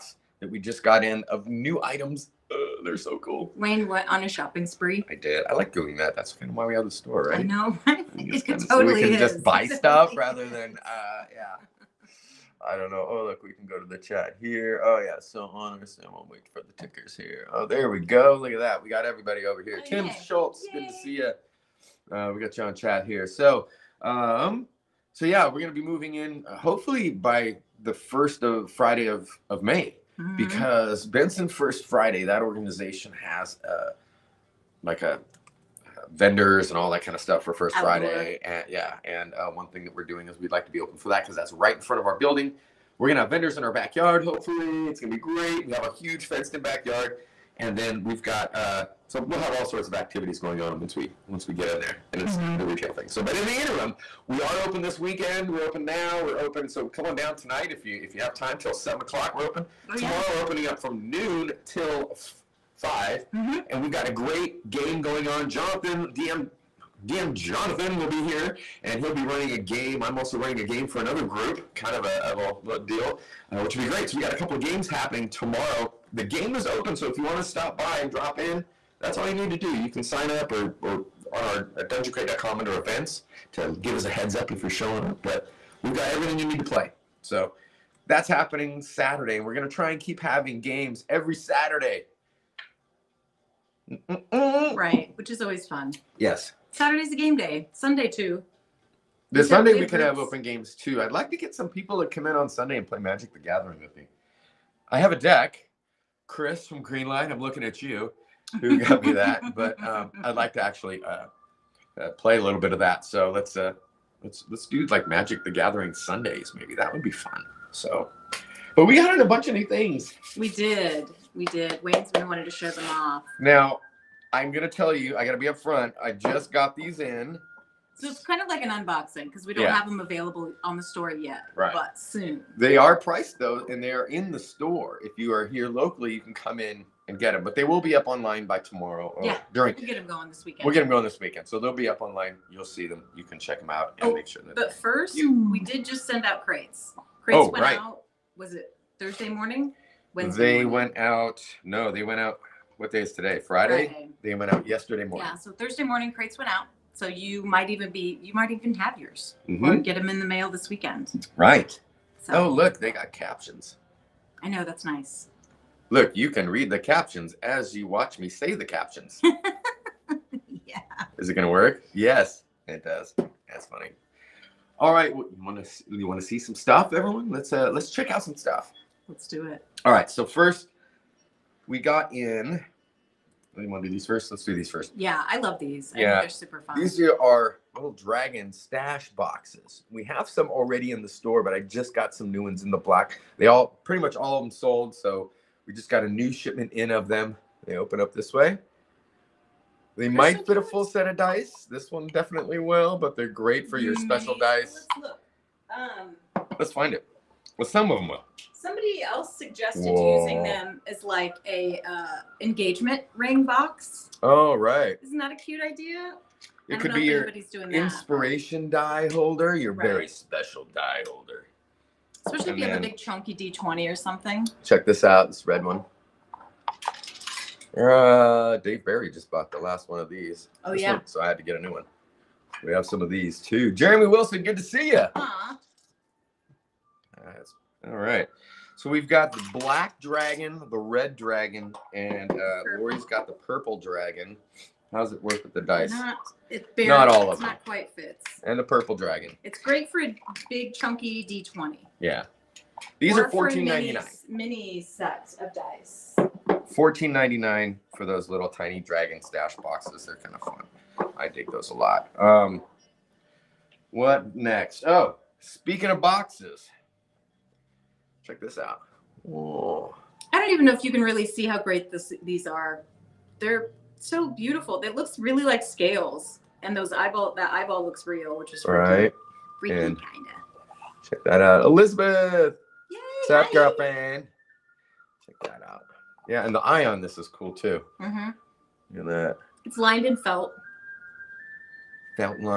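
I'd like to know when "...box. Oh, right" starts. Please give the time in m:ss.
3:33.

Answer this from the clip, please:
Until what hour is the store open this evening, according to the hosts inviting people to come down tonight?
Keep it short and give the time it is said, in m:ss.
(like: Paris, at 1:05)
7 o'clock, at 0:58.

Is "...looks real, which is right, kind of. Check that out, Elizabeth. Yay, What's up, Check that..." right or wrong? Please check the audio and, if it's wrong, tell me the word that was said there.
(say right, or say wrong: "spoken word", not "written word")
right.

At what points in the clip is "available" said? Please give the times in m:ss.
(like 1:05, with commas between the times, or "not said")
2:09.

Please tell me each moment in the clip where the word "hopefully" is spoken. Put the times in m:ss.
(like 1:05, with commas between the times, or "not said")
0:26, 0:44.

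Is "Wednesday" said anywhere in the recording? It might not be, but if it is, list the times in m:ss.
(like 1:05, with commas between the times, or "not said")
2:30.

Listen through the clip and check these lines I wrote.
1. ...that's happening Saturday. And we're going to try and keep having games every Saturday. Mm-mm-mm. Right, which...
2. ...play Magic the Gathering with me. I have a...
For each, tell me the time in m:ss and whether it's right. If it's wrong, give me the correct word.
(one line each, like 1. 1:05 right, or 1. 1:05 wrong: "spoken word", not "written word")
1. 1:28 right
2. 1:42 right.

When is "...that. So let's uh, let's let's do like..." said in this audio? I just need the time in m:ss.
1:52.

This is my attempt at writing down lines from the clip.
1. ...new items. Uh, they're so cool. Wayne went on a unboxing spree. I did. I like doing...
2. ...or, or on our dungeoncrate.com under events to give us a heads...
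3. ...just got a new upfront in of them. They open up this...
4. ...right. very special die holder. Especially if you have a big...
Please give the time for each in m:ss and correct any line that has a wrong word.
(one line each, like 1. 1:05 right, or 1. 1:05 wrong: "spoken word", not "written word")
1. 0:01 wrong: "shopping", not "unboxing"
2. 1:20 right
3. 3:15 wrong: "shipment", not "upfront"
4. 3:39 right.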